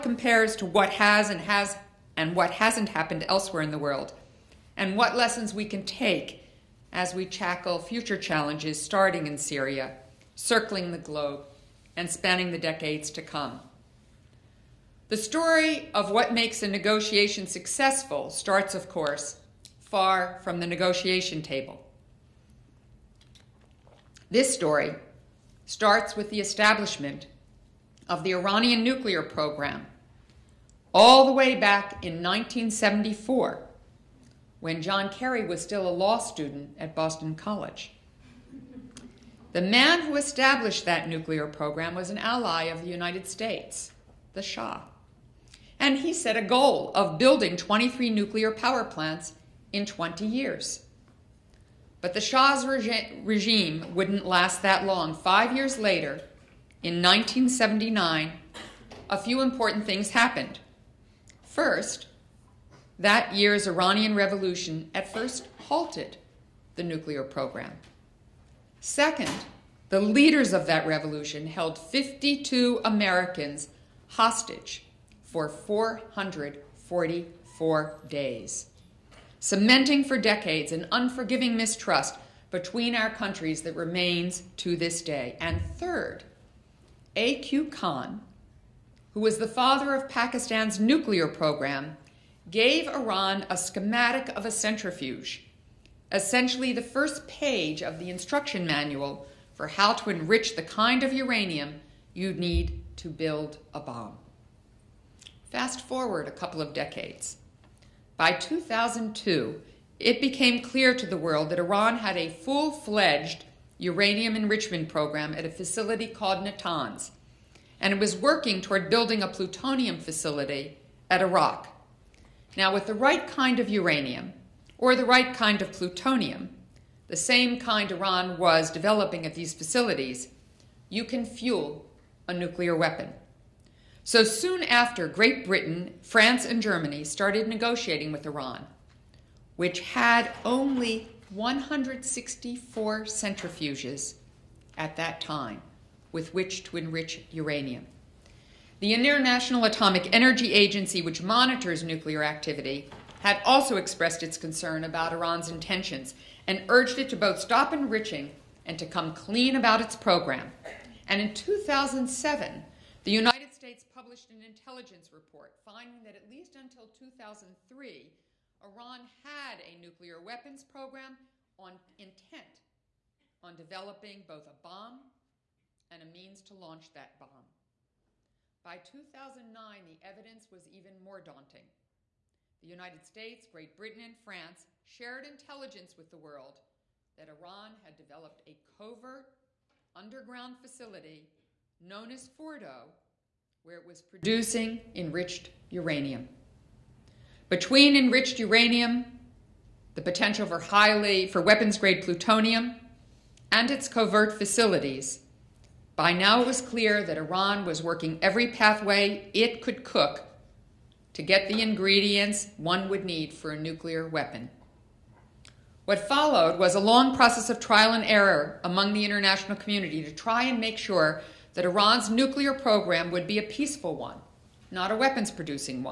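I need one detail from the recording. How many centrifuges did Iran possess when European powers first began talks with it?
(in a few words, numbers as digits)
164.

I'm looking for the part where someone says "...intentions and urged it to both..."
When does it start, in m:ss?
2:35.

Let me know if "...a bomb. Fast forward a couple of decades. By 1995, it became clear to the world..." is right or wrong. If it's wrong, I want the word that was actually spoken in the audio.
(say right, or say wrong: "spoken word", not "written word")
wrong: "2002", not "1995".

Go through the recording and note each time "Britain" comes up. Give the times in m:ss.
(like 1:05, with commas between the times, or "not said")
2:15, 3:03.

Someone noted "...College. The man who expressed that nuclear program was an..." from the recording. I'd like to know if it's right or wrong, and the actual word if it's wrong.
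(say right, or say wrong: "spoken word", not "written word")
wrong: "established", not "expressed".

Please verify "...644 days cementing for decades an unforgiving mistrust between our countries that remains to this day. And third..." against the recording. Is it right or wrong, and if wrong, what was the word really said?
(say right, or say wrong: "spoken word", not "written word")
wrong: "444", not "644".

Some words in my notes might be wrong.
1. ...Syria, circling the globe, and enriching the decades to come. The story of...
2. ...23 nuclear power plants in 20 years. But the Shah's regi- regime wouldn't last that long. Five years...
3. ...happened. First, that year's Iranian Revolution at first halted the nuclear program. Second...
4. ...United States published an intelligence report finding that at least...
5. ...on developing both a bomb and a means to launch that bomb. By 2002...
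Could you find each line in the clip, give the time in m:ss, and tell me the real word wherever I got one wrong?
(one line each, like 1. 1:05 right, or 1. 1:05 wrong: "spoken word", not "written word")
1. 0:09 wrong: "spanning", not "enriching"
2. 0:47 right
3. 1:00 right
4. 2:43 right
5. 2:53 wrong: "2009", not "2002".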